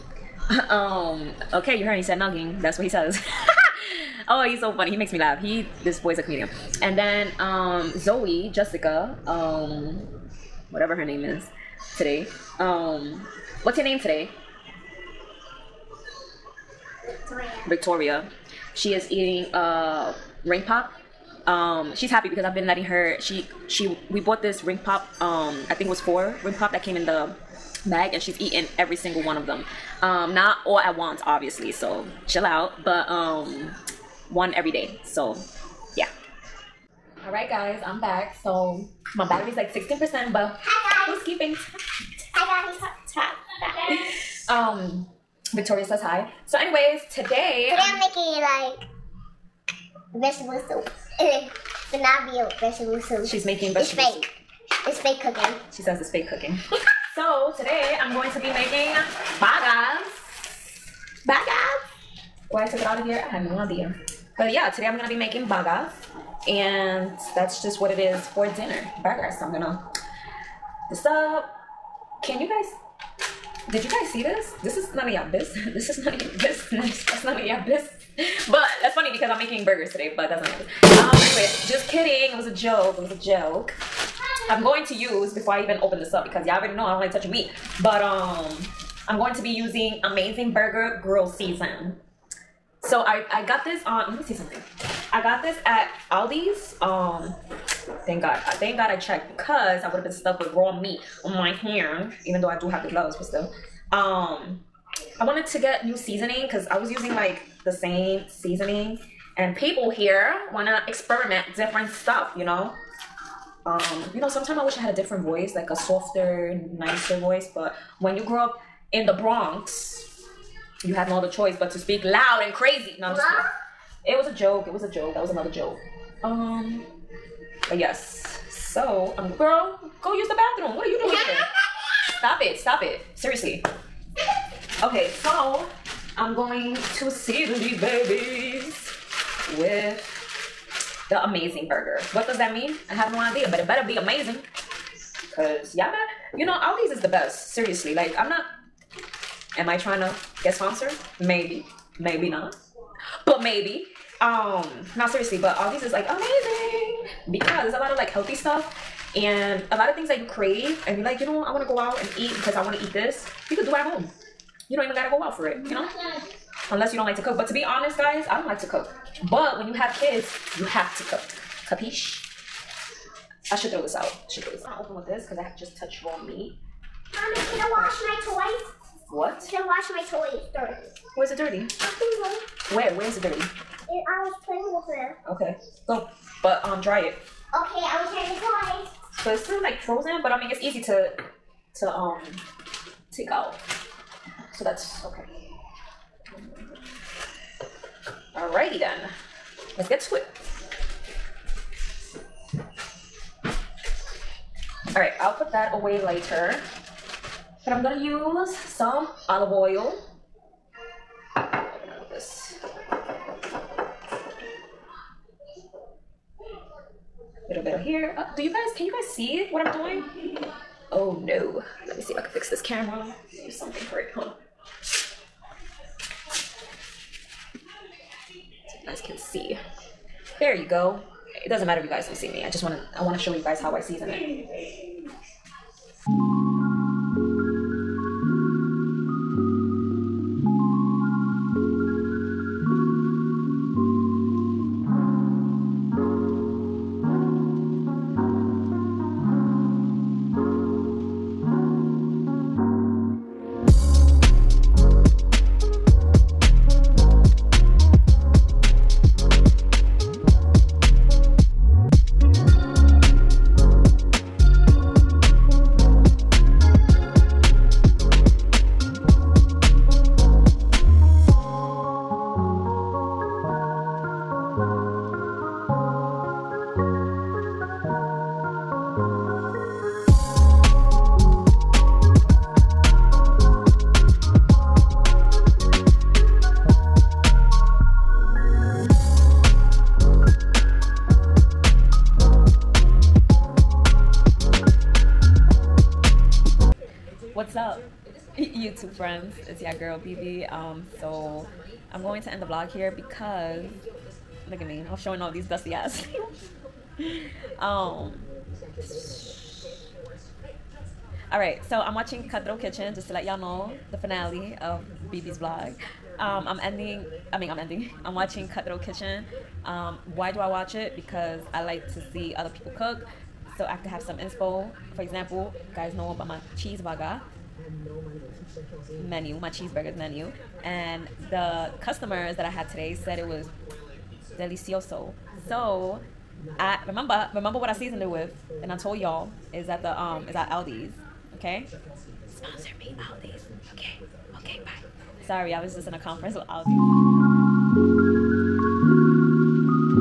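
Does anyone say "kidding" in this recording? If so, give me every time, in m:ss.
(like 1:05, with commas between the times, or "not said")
1:21, 2:03.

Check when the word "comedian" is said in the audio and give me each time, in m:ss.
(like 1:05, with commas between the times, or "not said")
0:06.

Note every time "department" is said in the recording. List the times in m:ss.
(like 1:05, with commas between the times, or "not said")
not said.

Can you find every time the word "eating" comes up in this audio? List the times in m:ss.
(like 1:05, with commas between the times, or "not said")
0:19, 0:28.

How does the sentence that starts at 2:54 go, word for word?
i'm gonna open with this because i just touched raw meat Mommy, can I wash my toys?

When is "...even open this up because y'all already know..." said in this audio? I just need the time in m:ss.
1:25.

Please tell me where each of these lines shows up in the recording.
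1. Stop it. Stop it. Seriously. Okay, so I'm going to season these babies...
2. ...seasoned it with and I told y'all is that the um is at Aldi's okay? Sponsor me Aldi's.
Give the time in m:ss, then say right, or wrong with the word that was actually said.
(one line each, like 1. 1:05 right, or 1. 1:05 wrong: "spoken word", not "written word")
1. 2:12 right
2. 5:37 right.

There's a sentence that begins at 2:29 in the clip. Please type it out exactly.
Am I trying to get sponsored?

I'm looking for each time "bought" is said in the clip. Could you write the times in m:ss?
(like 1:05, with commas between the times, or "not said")
0:24.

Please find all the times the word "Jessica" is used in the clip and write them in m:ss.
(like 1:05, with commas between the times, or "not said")
0:08.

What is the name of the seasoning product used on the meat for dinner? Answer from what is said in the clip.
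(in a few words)
Amazing Burger Grill Season.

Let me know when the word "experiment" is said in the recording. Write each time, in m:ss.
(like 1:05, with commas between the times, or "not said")
1:50.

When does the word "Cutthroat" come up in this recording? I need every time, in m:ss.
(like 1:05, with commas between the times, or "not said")
5:12, 5:18.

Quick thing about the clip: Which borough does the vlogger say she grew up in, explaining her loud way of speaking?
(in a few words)
the Bronx.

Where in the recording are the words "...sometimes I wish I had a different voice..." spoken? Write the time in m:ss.
1:54.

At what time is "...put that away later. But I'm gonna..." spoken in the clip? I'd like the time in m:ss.
3:25.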